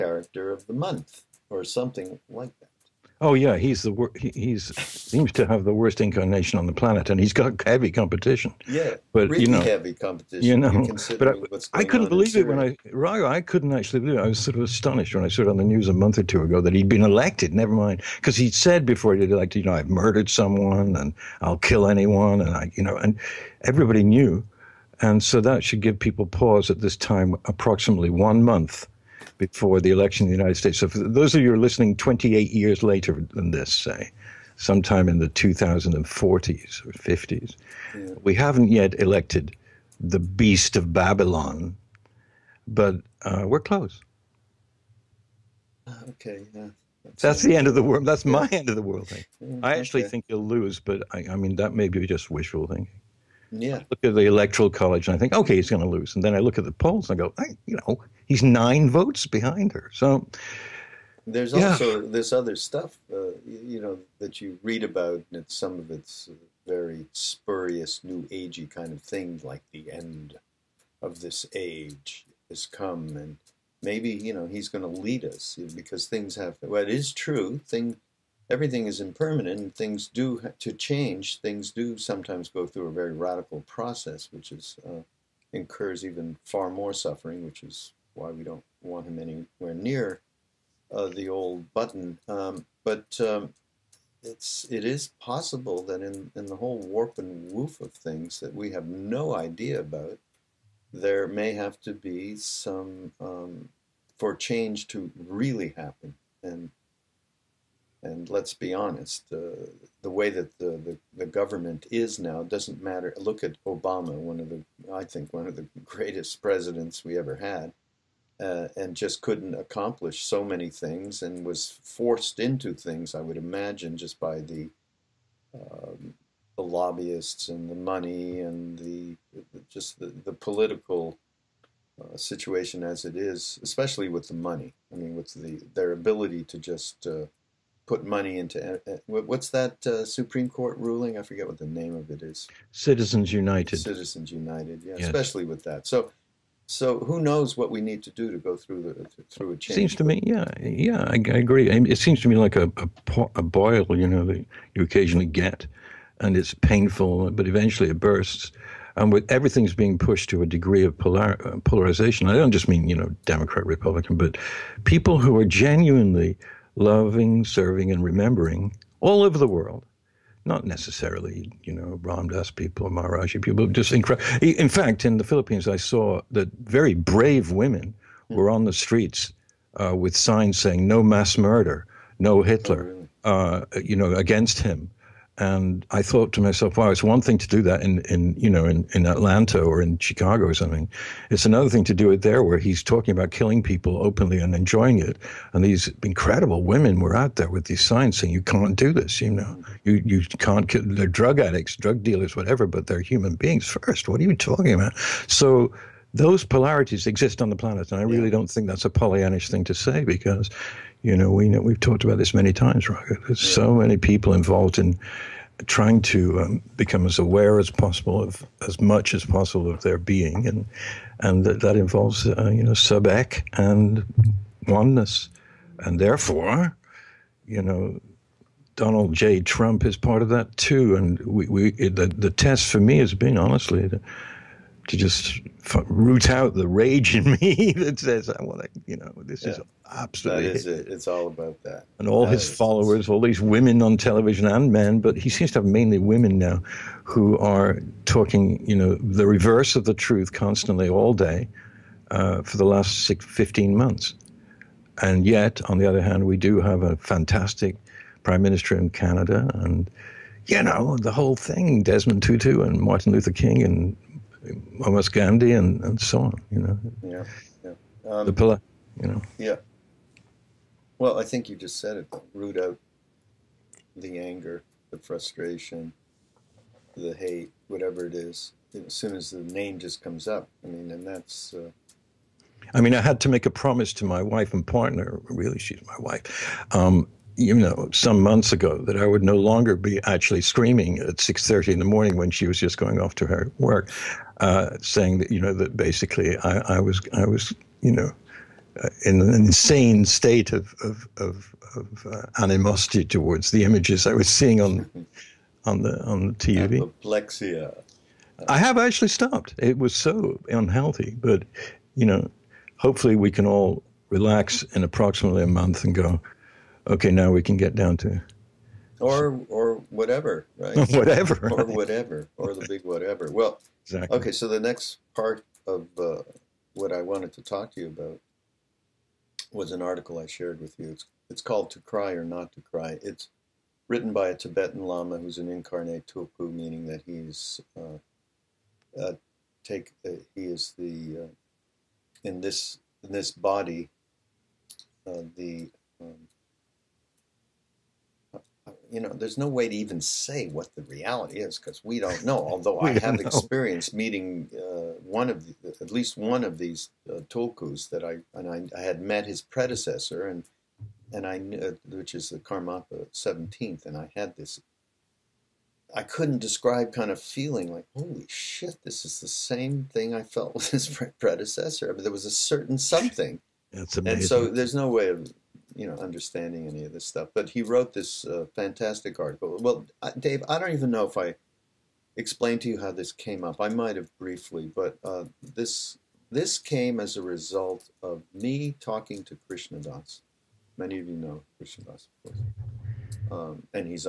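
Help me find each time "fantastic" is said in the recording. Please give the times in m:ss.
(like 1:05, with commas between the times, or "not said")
4:16, 6:18.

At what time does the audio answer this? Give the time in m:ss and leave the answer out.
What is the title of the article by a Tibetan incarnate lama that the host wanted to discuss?
5:31.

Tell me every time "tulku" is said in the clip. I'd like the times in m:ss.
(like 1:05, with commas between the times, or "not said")
5:36, 5:57.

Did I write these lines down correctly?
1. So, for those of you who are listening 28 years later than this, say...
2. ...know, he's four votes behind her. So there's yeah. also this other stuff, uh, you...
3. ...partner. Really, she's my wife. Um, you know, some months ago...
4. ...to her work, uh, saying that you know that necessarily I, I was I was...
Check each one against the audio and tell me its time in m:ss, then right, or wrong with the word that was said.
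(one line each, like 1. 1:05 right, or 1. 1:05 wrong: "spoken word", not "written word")
1. 0:30 right
2. 0:57 wrong: "nine", not "four"
3. 4:44 right
4. 4:53 wrong: "basically", not "necessarily".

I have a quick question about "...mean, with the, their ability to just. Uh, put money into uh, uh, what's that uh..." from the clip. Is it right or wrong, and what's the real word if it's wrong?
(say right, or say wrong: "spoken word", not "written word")
right.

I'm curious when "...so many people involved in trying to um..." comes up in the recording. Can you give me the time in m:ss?
3:33.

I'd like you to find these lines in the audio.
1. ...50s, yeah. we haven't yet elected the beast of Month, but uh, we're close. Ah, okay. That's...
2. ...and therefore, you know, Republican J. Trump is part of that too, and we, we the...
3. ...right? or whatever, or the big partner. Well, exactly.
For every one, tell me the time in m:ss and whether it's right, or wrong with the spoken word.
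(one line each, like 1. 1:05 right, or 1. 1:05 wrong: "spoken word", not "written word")
1. 0:36 wrong: "Babylon", not "Month"
2. 3:45 wrong: "Donald", not "Republican"
3. 5:21 wrong: "whatever", not "partner".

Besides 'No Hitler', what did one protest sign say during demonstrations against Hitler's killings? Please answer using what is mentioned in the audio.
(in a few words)
No mass murder.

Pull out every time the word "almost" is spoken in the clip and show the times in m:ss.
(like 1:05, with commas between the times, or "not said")
4:24.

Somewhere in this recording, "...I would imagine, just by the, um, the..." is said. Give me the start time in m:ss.
2:03.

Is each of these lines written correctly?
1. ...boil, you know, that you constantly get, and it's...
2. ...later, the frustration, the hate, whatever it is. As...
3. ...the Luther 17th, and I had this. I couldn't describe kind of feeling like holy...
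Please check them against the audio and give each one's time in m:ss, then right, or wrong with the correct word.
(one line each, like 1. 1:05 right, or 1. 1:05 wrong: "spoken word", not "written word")
1. 2:33 wrong: "occasionally", not "constantly"
2. 4:34 wrong: "anger", not "later"
3. 6:02 wrong: "Karmapa", not "Luther".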